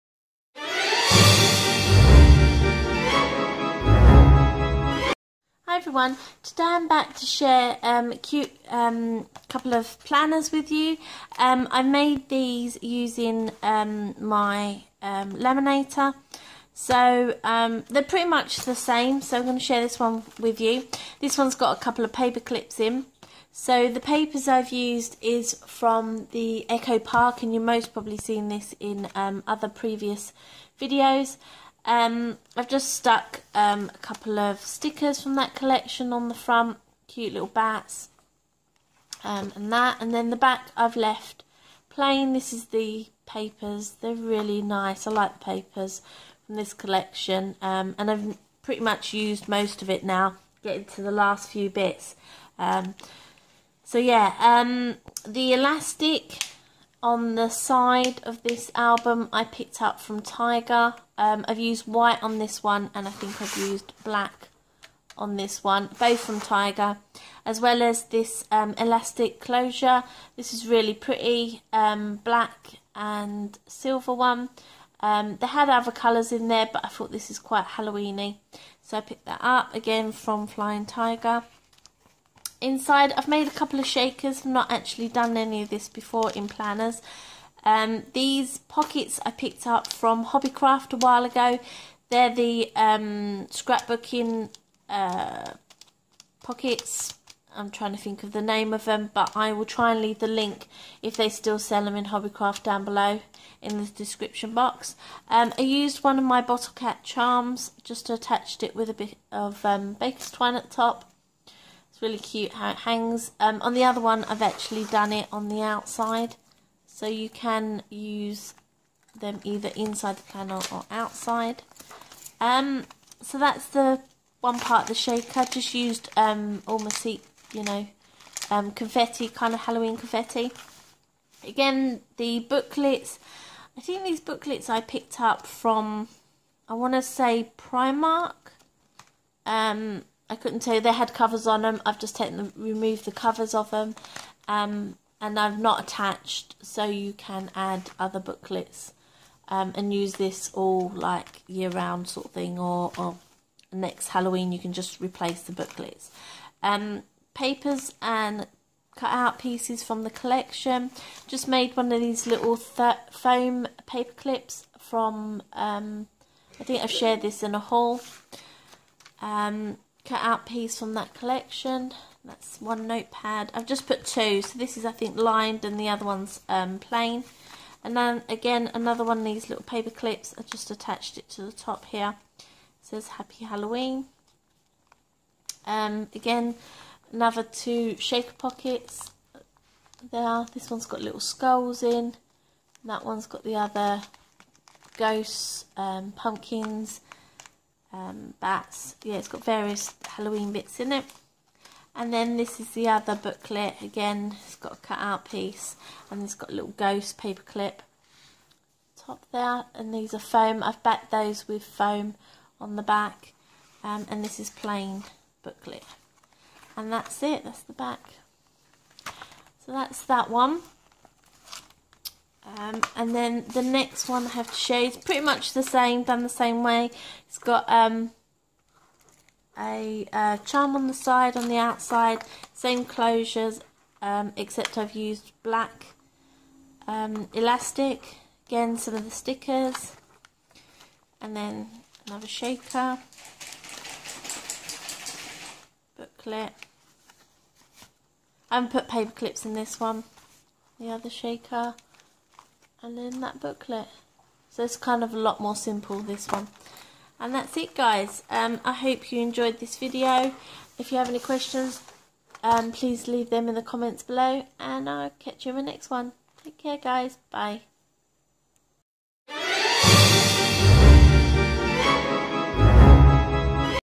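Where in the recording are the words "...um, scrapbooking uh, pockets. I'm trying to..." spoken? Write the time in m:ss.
1:32.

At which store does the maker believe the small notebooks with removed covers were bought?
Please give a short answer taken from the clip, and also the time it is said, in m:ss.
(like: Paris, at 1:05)
Primark, at 2:17.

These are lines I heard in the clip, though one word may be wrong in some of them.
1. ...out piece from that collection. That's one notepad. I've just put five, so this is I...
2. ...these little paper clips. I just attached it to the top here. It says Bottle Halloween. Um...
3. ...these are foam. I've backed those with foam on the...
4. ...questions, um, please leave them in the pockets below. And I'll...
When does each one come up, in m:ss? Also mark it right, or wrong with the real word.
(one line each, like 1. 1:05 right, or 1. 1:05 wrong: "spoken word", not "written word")
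1. 2:50 wrong: "two", not "five"
2. 2:59 wrong: "Happy", not "Bottle"
3. 3:29 right
4. 4:21 wrong: "comments", not "pockets".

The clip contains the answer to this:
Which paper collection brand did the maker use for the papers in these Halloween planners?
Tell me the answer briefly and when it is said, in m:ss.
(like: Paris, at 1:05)
Echo Park, at 0:26.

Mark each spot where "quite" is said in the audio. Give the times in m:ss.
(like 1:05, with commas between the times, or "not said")
1:17.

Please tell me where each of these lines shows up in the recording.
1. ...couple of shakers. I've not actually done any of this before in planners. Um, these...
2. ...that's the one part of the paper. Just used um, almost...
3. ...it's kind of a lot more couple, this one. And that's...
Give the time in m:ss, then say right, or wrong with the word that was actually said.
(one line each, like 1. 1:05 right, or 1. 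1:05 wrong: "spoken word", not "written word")
1. 1:23 right
2. 2:03 wrong: "shaker", not "paper"
3. 4:14 wrong: "simple", not "couple".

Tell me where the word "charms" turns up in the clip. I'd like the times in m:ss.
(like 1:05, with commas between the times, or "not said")
1:47, 3:50.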